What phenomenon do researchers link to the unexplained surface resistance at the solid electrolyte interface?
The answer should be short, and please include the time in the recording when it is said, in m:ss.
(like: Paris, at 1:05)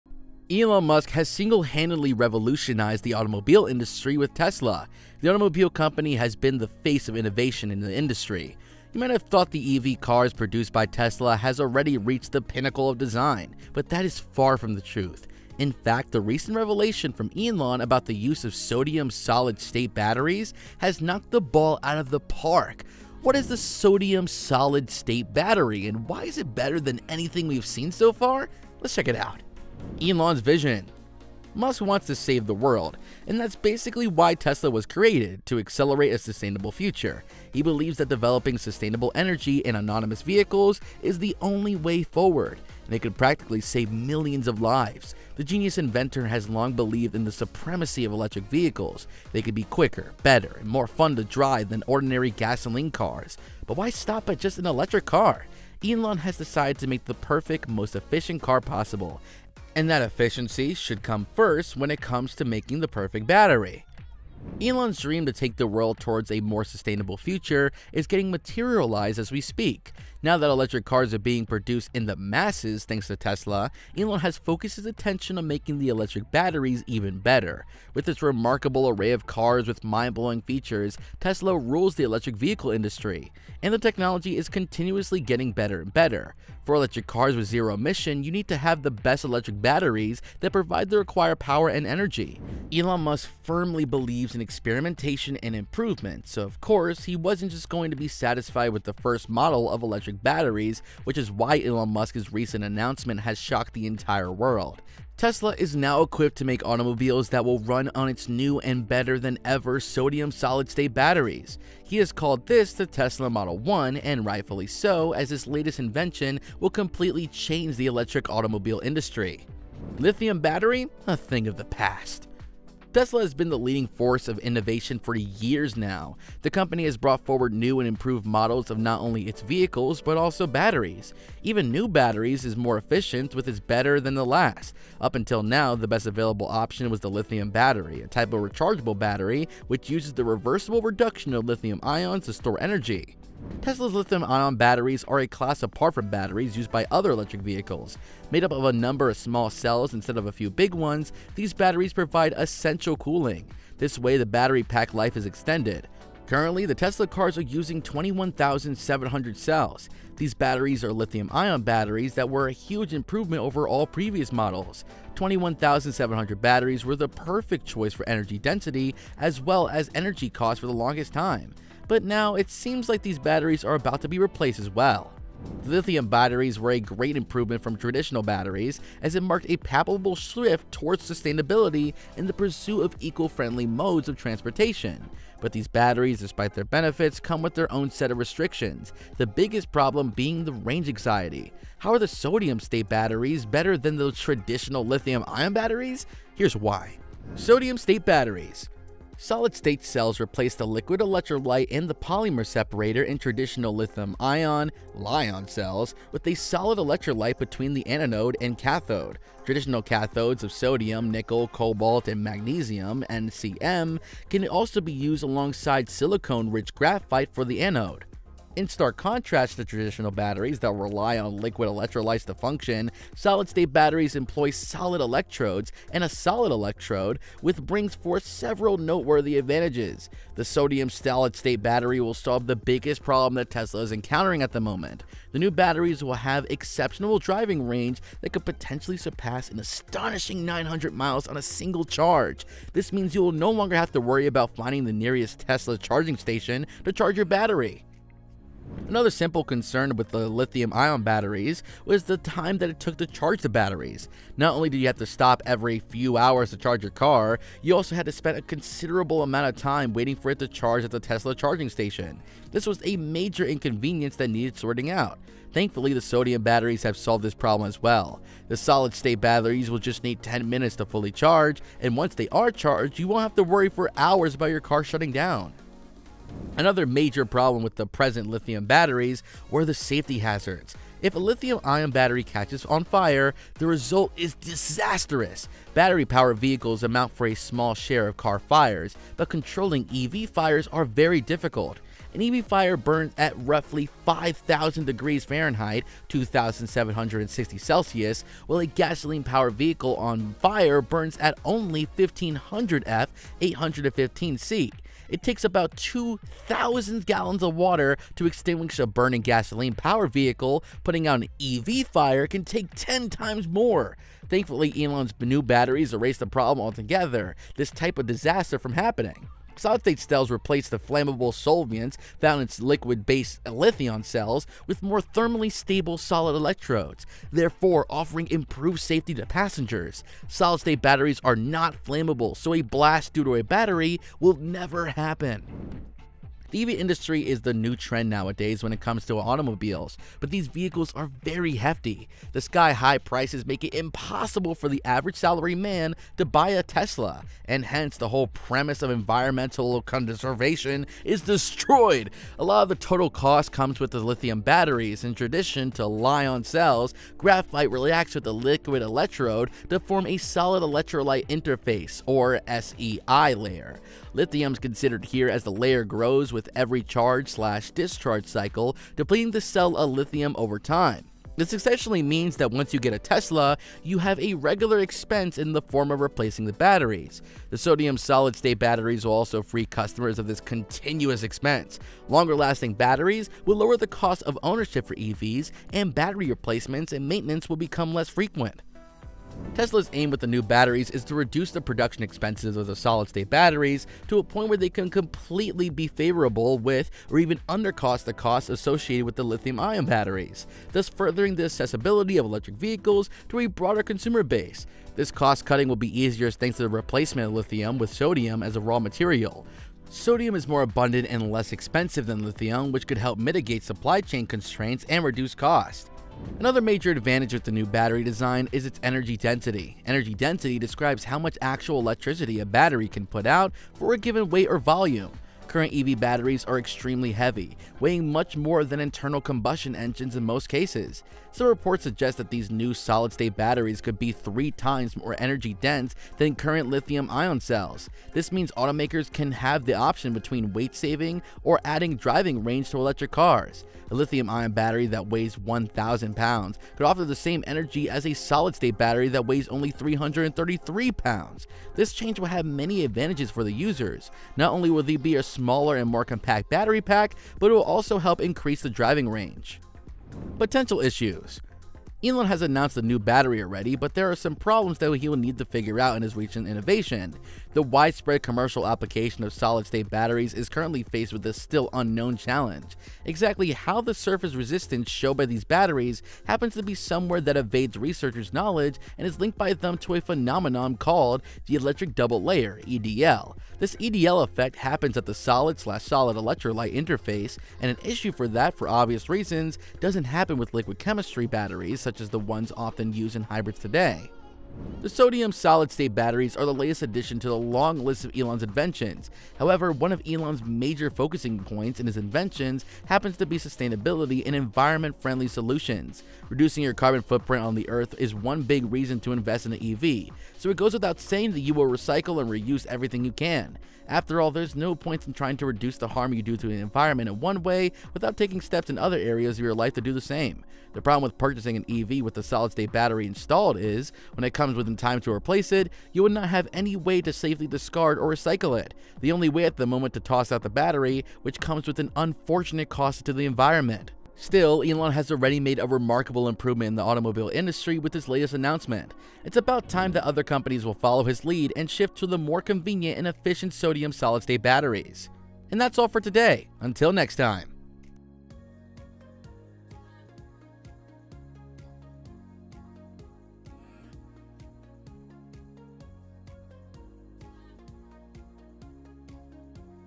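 electric double layer, at 8:01.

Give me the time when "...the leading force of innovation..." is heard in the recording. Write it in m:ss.
2:03.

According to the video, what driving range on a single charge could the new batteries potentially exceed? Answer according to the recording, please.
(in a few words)
900 miles.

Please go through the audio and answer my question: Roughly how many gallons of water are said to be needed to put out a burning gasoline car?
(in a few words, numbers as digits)
2,000 gallons.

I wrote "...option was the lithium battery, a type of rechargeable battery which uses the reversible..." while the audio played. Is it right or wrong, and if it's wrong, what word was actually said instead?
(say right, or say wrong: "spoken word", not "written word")
right.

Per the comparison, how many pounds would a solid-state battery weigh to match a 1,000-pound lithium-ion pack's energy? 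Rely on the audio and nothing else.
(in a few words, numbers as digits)
333 pounds.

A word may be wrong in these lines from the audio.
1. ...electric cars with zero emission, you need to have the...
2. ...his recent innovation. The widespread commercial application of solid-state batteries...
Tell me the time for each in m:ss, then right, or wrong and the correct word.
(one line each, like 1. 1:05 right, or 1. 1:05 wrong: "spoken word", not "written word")
1. 1:26 right
2. 7:46 right.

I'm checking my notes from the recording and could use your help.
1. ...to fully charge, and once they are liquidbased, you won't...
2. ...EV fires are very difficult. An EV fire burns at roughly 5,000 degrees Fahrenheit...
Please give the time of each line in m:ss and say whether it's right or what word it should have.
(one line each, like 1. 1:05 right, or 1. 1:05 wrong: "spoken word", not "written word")
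1. 4:30 wrong: "charged", not "liquidbased"
2. 4:49 right.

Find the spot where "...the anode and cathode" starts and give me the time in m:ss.
3:27.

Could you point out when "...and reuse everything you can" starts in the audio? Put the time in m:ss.
8:32.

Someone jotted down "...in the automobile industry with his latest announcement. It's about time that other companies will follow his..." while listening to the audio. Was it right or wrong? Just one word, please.
right.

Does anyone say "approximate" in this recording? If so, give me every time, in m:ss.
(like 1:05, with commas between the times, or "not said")
not said.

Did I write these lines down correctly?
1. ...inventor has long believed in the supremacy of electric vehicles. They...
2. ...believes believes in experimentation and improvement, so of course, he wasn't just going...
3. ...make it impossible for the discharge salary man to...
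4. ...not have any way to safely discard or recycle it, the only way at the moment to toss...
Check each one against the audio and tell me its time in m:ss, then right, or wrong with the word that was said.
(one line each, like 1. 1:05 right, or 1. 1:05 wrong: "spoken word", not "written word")
1. 0:45 right
2. 1:33 right
3. 5:43 wrong: "average", not "discharge"
4. 8:46 right.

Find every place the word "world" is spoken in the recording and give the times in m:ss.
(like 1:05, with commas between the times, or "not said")
0:32, 1:05, 1:44.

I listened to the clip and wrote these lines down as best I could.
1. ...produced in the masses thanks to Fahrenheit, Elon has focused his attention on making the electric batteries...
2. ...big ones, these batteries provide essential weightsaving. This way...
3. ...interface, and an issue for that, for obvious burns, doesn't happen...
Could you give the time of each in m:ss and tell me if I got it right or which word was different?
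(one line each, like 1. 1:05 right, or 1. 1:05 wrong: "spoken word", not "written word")
1. 1:11 wrong: "Tesla", not "Fahrenheit"
2. 2:30 wrong: "cooling", not "weightsaving"
3. 8:06 wrong: "reasons", not "burns".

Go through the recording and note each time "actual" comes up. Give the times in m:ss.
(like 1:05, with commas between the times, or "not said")
7:01.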